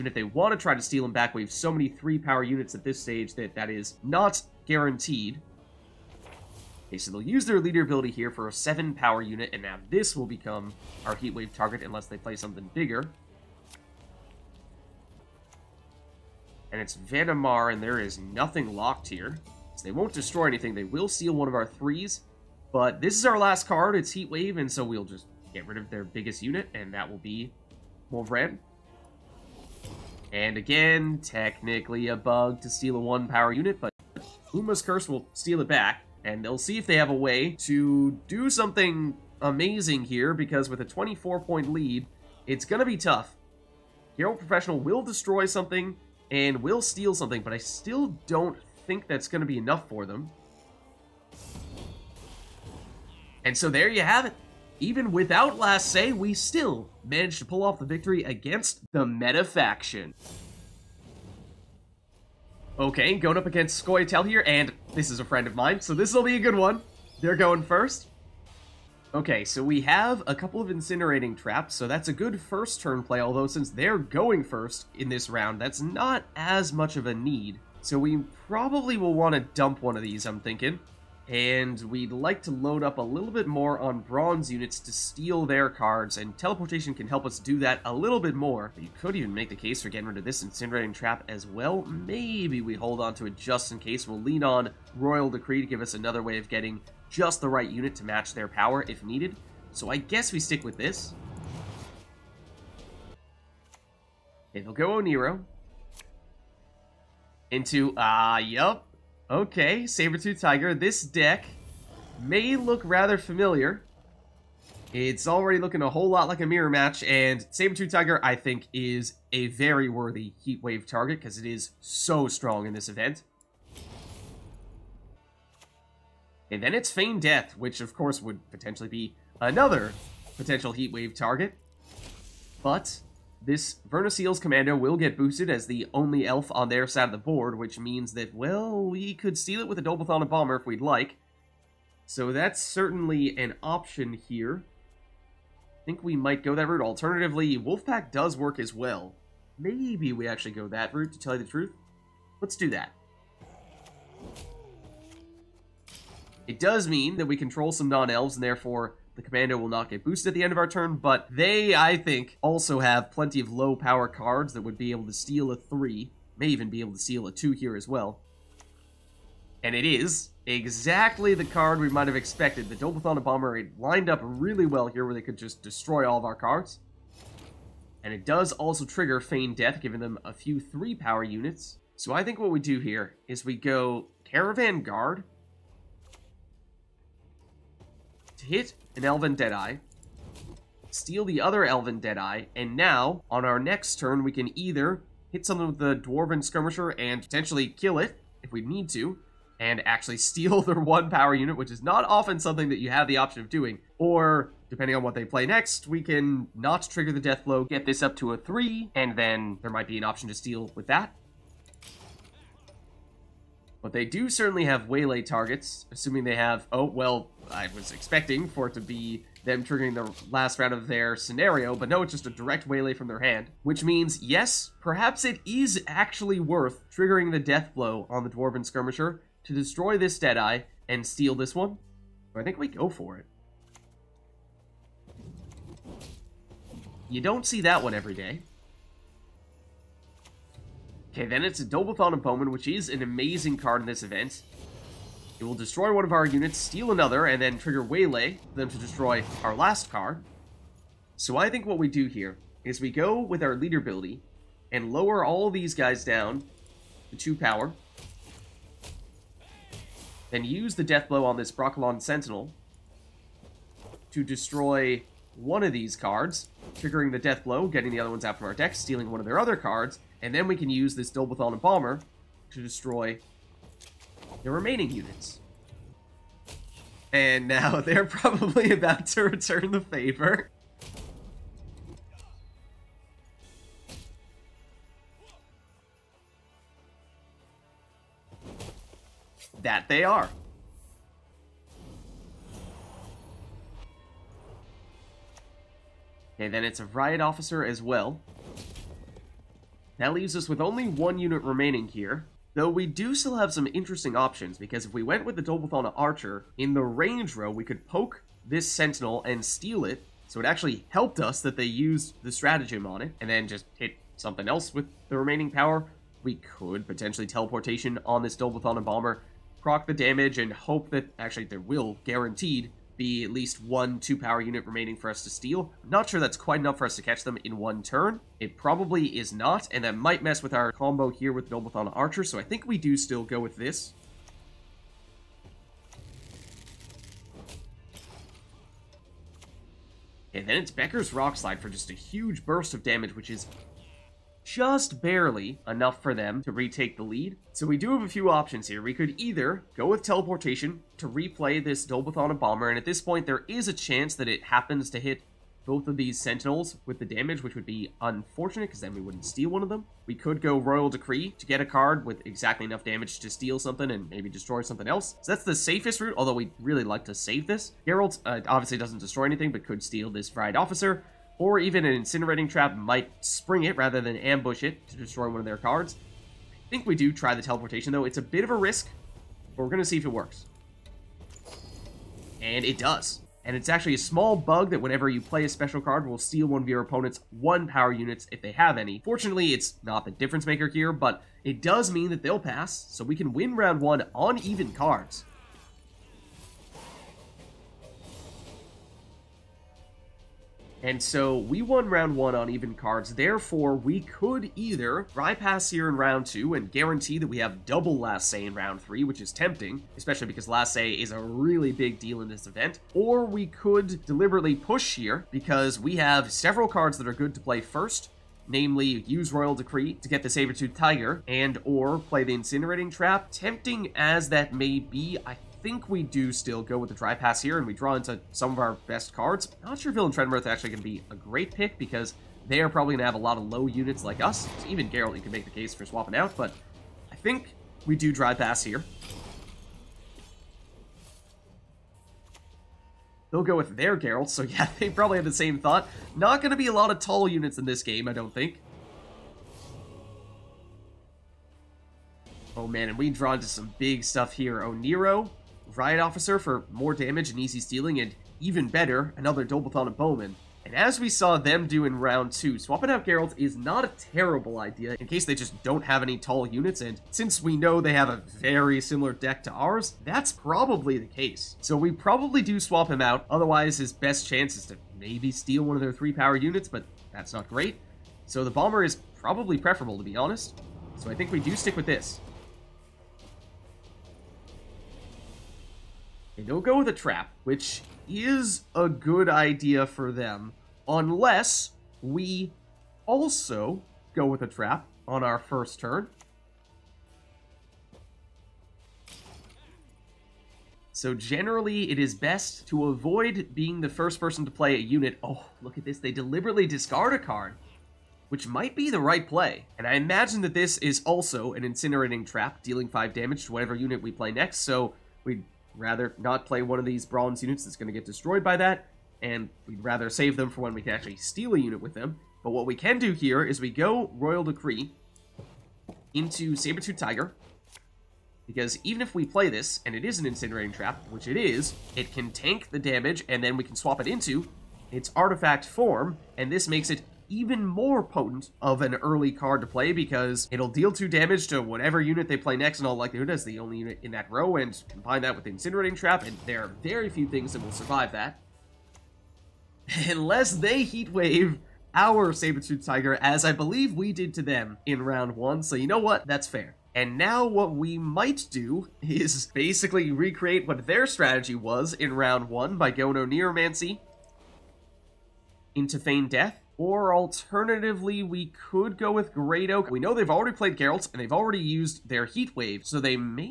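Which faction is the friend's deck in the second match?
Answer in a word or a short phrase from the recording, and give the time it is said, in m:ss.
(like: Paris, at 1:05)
Scoia'tael, at 1:03.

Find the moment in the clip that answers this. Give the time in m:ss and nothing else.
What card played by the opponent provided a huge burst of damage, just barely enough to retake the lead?
5:40.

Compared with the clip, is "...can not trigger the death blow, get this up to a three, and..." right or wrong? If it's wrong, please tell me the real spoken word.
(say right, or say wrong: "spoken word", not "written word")
right.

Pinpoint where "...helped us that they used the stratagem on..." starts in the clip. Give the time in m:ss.
5:10.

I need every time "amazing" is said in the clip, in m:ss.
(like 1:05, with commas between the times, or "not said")
0:39, 4:03.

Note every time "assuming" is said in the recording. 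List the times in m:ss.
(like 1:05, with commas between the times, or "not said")
3:35.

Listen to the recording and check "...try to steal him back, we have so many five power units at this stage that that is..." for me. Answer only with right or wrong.
wrong.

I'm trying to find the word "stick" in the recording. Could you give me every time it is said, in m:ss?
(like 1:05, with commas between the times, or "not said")
1:40, 8:01.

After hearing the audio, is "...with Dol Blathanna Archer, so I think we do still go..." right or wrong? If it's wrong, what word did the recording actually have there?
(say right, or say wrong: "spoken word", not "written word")
right.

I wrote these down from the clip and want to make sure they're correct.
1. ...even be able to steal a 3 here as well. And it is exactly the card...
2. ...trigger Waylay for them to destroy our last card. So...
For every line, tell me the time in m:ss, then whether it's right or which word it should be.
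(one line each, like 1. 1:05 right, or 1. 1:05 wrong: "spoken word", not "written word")
1. 2:46 wrong: "2", not "3"
2. 4:07 right.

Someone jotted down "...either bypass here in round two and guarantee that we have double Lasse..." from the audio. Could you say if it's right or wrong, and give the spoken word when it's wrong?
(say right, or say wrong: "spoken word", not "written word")
right.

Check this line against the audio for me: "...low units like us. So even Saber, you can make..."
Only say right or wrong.
wrong.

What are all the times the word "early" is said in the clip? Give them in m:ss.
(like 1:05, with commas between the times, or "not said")
8:58.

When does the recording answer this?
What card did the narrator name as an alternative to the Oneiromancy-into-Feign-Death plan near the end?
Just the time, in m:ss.
9:29.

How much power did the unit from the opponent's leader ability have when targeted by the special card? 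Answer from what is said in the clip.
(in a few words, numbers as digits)
7.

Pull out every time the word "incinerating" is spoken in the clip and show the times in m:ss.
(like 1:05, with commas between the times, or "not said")
1:10, 1:30, 6:12, 7:02, 8:31, 8:50, 9:05.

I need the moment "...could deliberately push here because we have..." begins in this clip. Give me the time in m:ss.
6:53.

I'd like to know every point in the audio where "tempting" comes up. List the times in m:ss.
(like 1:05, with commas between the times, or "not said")
6:49, 7:03.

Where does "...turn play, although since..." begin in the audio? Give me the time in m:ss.
1:12.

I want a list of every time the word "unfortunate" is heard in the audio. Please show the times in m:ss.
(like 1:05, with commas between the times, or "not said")
5:57.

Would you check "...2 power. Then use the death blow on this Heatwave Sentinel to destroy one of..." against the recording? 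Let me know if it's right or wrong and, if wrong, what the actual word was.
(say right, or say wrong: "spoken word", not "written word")
wrong: "Brokilon", not "Heatwave".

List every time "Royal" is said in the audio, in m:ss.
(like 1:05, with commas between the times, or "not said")
1:34, 6:00, 6:59, 8:44.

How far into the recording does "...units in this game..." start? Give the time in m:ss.
7:27.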